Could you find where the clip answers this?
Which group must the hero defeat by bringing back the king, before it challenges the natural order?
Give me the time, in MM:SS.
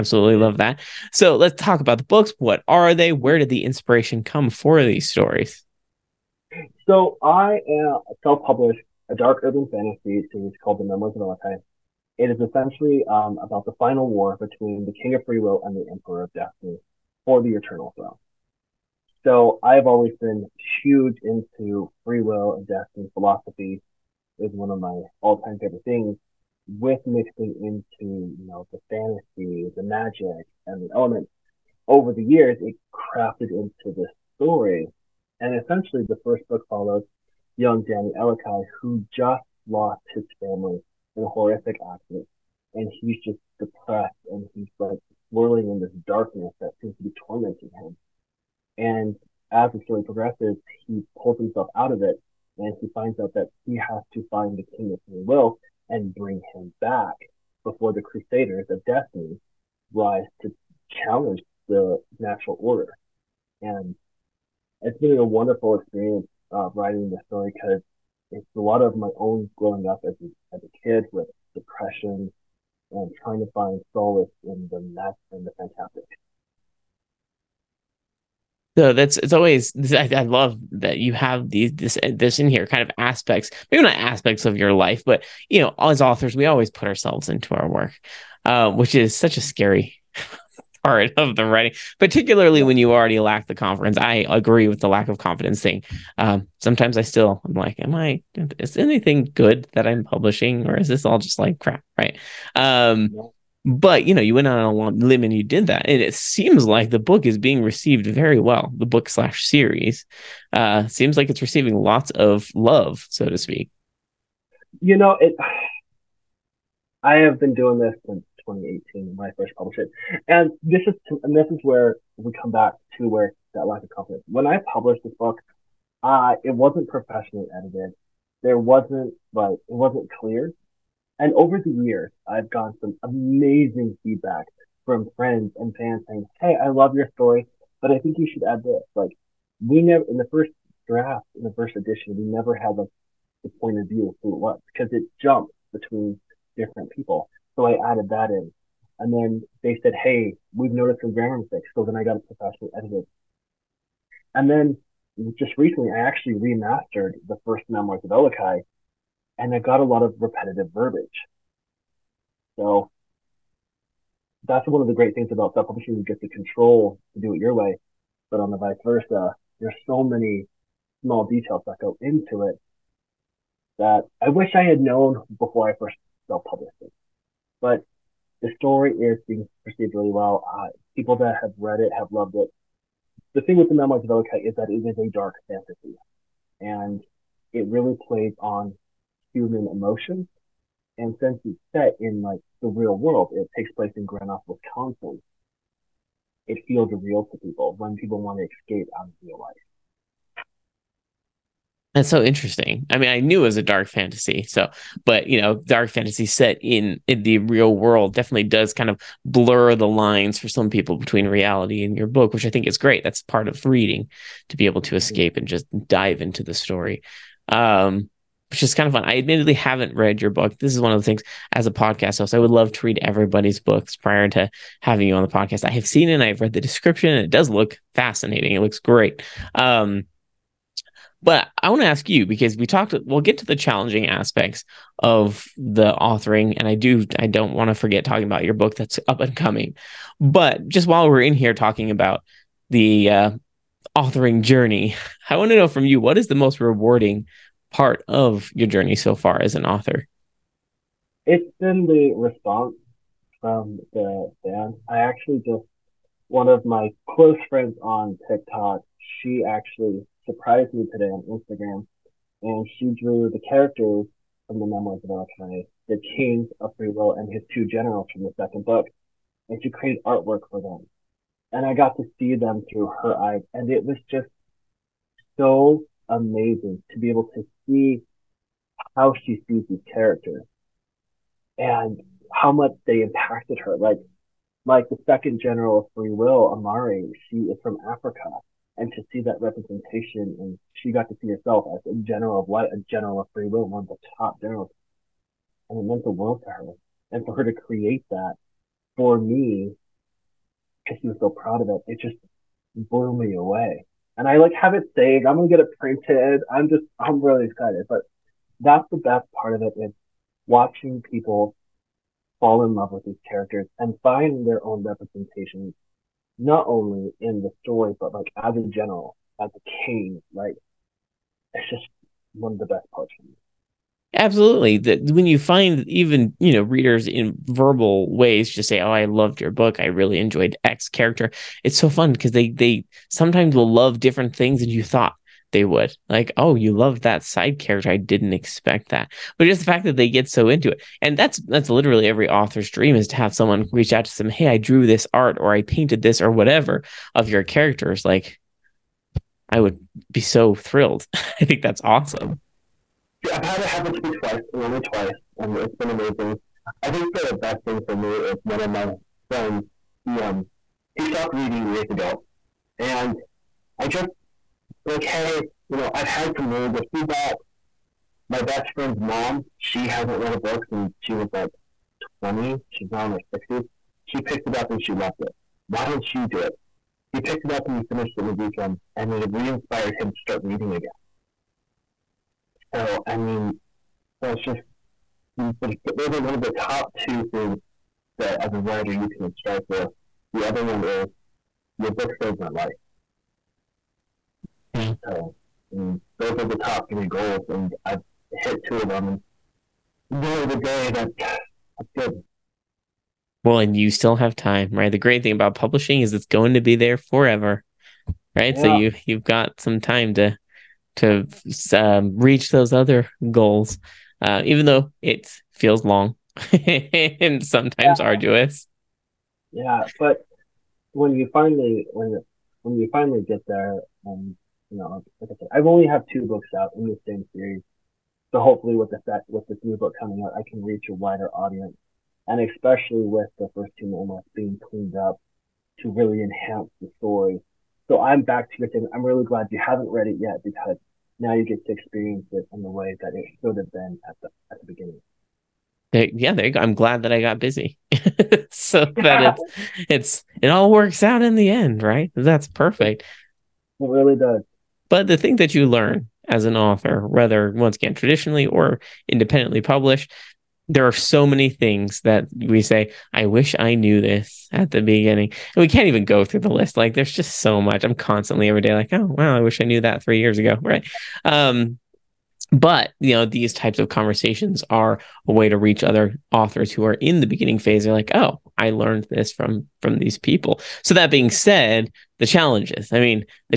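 00:58.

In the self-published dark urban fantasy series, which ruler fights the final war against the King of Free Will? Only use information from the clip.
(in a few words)
Emperor of Destiny.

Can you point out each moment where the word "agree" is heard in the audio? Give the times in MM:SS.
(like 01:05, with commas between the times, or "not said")
01:34.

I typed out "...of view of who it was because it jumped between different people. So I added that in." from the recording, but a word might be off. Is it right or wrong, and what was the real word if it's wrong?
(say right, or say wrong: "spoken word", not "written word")
right.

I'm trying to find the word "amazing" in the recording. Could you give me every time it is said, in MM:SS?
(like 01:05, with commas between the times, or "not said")
02:13, 04:36, 05:55.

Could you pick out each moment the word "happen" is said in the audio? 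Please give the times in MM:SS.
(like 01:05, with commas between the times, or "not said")
05:53.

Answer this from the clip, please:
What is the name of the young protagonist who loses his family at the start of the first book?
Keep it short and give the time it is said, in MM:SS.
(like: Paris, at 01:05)
Danny Elikai, at 00:37.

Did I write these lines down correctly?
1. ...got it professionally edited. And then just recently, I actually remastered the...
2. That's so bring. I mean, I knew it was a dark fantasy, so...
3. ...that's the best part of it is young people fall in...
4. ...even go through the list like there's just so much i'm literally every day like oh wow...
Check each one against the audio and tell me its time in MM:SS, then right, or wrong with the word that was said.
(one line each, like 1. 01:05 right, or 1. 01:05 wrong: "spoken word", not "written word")
1. 02:32 right
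2. 03:21 wrong: "interesting", not "bring"
3. 05:08 wrong: "watching", not "young"
4. 07:45 wrong: "constantly", not "literally".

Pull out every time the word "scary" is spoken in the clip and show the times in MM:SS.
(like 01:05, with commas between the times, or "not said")
01:29.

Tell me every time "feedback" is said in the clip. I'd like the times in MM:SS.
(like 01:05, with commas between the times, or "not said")
02:14, 06:06.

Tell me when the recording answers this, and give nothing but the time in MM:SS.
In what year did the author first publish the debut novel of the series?
01:58.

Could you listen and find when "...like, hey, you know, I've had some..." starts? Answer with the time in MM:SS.
06:04.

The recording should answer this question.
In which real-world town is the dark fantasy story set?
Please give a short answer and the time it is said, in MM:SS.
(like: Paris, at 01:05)
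Grand Island, Wisconsin, at 03:14.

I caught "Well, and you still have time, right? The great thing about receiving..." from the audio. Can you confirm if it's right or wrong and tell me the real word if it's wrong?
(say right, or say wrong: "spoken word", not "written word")
wrong: "publishing", not "receiving".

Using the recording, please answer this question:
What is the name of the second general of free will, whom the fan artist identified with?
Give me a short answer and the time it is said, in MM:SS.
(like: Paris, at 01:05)
Amari, at 04:46.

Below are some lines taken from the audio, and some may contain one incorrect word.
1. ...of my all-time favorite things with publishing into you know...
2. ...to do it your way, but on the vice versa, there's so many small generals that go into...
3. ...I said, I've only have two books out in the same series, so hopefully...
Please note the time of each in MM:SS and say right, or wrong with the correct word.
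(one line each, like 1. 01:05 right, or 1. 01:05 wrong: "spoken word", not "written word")
1. 00:24 wrong: "mixing", not "publishing"
2. 02:47 wrong: "details", not "generals"
3. 07:05 right.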